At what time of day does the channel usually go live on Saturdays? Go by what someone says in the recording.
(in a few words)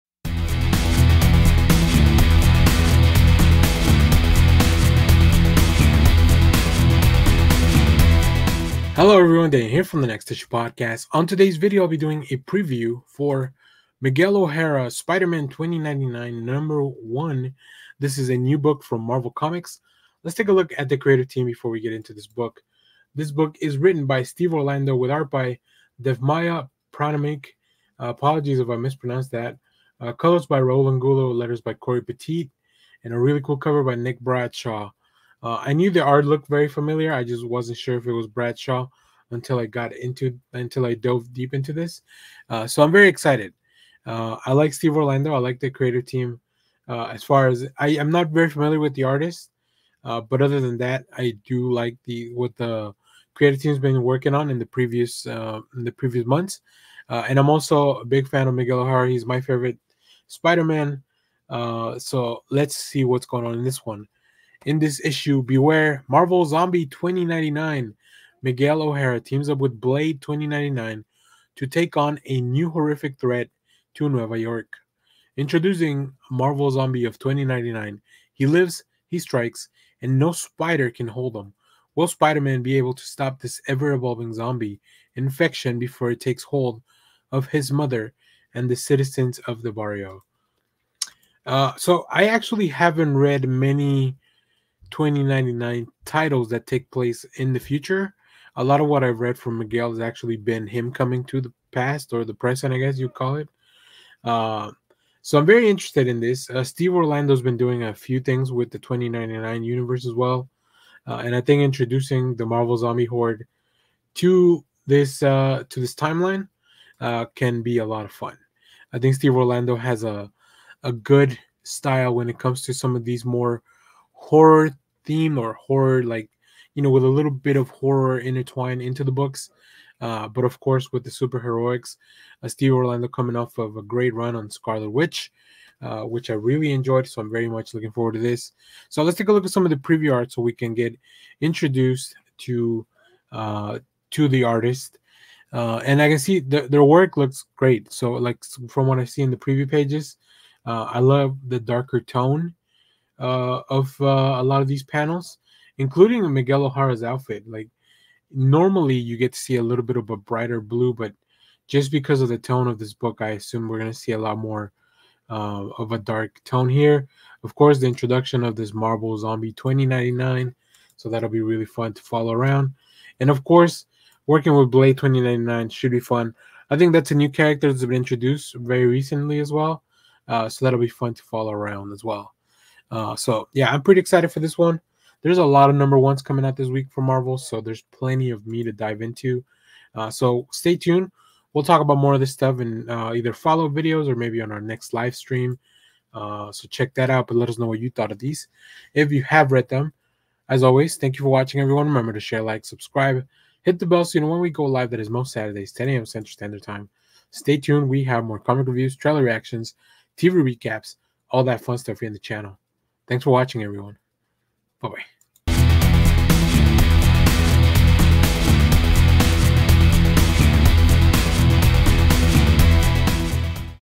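10 a.m.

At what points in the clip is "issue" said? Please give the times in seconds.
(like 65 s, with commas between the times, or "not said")
10 s, 65 s.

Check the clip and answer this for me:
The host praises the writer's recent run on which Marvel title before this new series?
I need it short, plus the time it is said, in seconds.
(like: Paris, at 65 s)
Scarlet Witch, at 134 s.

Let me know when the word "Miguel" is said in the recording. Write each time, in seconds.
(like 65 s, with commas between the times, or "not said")
13 s, 58 s, 68 s, 99 s, 156 s.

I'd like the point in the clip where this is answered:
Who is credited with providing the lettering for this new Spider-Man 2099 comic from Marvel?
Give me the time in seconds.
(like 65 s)
31 s.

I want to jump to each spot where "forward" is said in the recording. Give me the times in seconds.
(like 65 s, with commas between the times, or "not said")
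137 s.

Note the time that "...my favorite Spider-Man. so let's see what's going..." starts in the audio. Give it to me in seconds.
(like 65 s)
59 s.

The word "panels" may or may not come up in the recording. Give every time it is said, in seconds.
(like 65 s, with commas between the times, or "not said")
154 s.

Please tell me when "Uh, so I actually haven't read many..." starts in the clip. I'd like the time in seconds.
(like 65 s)
91 s.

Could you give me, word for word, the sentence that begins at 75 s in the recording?
Introducing Marvel Zombie of 2099, he lives, he strikes, and no spider can hold him.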